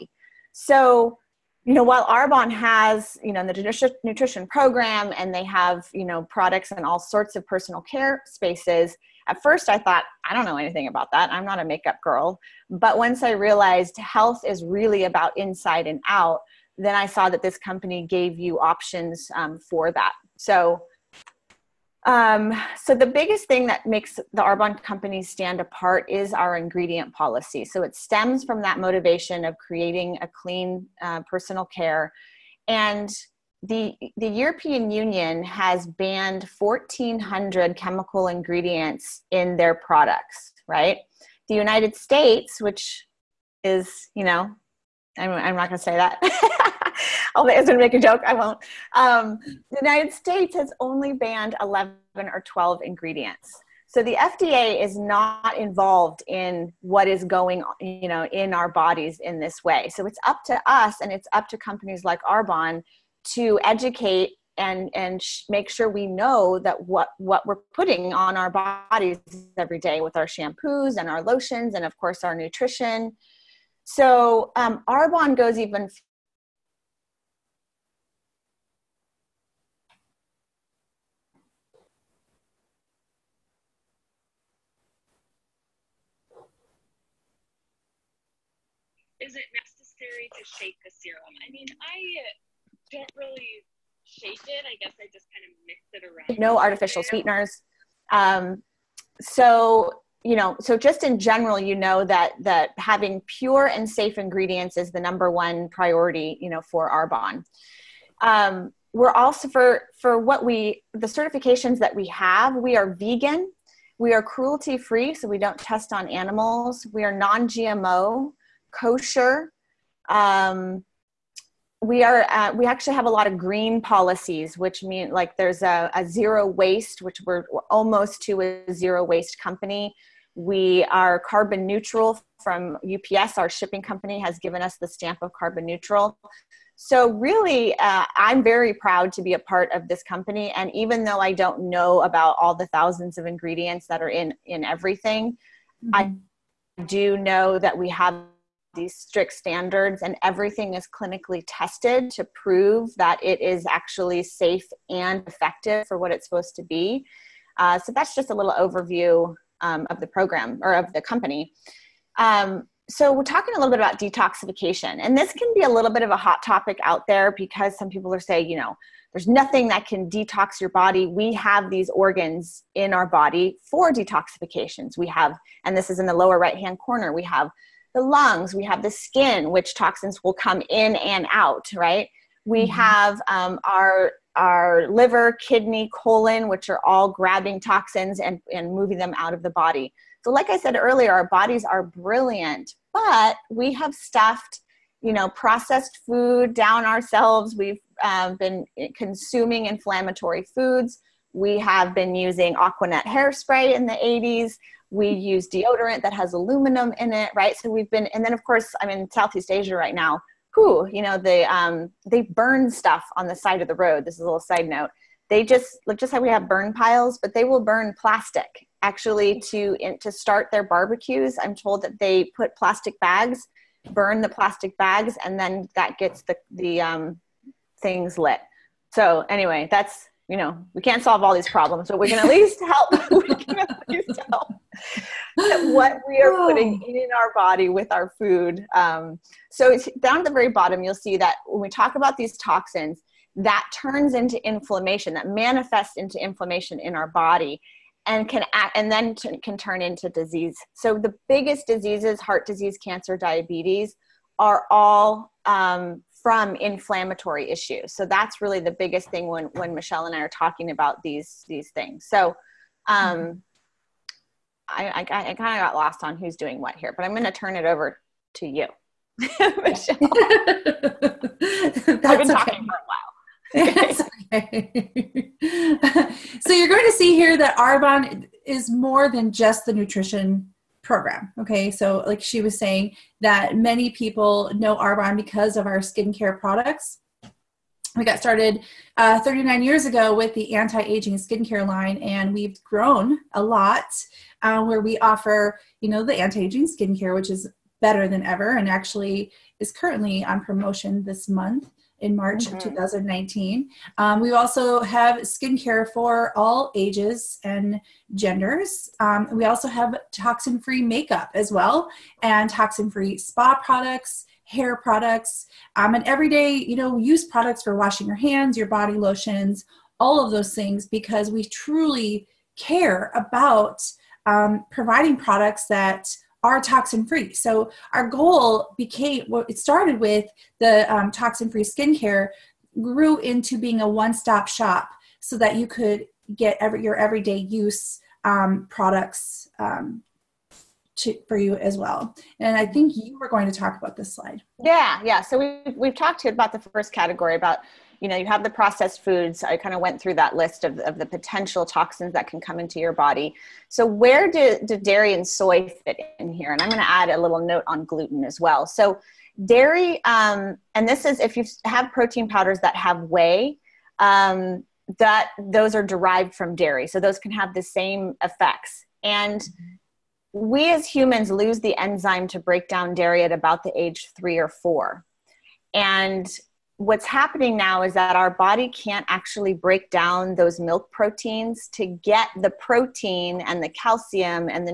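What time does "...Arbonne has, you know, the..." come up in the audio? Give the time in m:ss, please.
0:02.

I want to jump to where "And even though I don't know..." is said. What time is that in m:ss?
2:20.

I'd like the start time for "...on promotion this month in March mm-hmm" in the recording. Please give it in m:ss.
5:00.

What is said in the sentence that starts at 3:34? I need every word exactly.
This is a little side note.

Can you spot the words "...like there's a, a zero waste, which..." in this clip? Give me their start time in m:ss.
2:05.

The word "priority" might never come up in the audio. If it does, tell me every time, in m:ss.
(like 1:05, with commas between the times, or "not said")
1:45.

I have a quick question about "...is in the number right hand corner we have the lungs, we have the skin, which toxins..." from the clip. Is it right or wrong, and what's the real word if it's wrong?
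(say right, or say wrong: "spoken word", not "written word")
wrong: "lower", not "number".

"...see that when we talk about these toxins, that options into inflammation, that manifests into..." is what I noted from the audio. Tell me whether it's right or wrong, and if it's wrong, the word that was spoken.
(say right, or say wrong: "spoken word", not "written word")
wrong: "turns", not "options".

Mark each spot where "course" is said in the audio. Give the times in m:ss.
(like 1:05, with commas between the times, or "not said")
1:11, 3:28.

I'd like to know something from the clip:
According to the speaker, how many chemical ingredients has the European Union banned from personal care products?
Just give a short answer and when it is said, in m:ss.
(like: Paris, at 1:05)
1,400, at 0:36.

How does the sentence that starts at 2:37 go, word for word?
Uh, so that's just a little overview um, of the program or of the company.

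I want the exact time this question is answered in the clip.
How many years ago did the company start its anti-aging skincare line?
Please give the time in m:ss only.
4:49.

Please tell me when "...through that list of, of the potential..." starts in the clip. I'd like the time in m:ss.
5:50.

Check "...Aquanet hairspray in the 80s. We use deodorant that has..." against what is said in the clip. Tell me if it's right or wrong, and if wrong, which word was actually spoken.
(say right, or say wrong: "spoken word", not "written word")
right.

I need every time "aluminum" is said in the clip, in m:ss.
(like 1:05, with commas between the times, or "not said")
3:26.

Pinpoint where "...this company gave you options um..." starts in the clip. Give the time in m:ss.
0:17.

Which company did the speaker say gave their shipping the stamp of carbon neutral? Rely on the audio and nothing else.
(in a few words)
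UPS.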